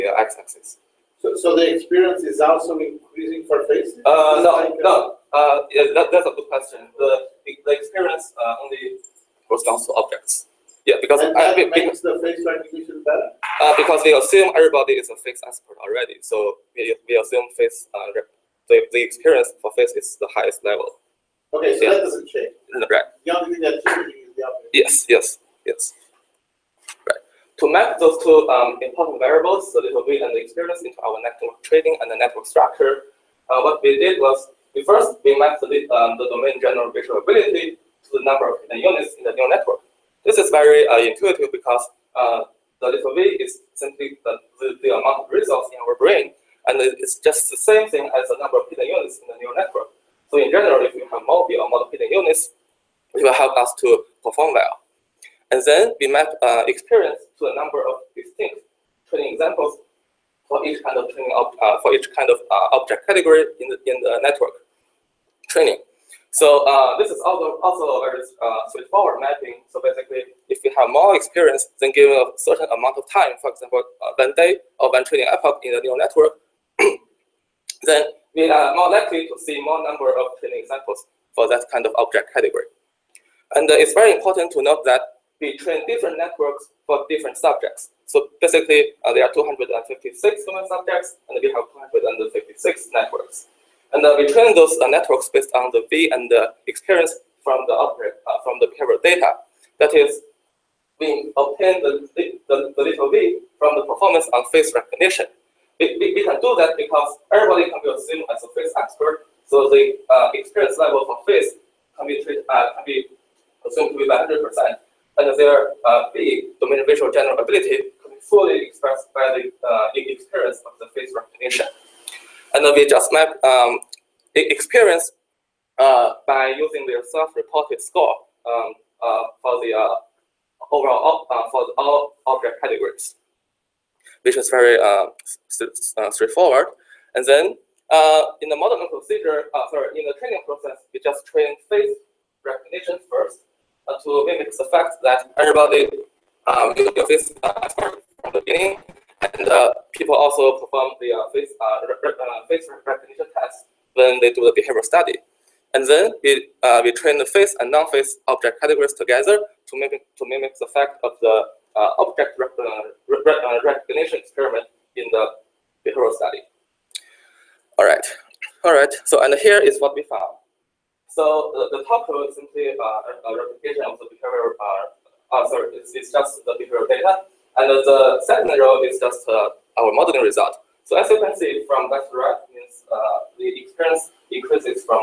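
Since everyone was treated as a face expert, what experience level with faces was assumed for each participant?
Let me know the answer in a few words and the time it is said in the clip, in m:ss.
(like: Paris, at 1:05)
100%, at 1:54.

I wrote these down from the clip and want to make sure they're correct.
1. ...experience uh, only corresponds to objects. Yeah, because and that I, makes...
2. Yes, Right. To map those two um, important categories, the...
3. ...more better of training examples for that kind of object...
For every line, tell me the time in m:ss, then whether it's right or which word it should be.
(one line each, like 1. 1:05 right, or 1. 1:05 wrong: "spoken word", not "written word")
1. 0:07 right
2. 0:25 wrong: "variables", not "categories"
3. 1:19 wrong: "number", not "better".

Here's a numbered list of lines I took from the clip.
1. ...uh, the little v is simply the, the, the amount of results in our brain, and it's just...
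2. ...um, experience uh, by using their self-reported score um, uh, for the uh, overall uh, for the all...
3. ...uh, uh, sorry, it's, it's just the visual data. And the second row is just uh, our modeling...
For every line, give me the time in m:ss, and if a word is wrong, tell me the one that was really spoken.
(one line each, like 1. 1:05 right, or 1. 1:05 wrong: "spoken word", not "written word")
1. 0:42 right
2. 2:03 right
3. 2:54 wrong: "behavioral", not "visual".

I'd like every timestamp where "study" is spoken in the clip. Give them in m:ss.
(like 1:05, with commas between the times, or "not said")
2:34, 2:46.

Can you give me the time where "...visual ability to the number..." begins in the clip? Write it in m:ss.
0:36.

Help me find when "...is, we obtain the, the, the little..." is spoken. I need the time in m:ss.
1:39.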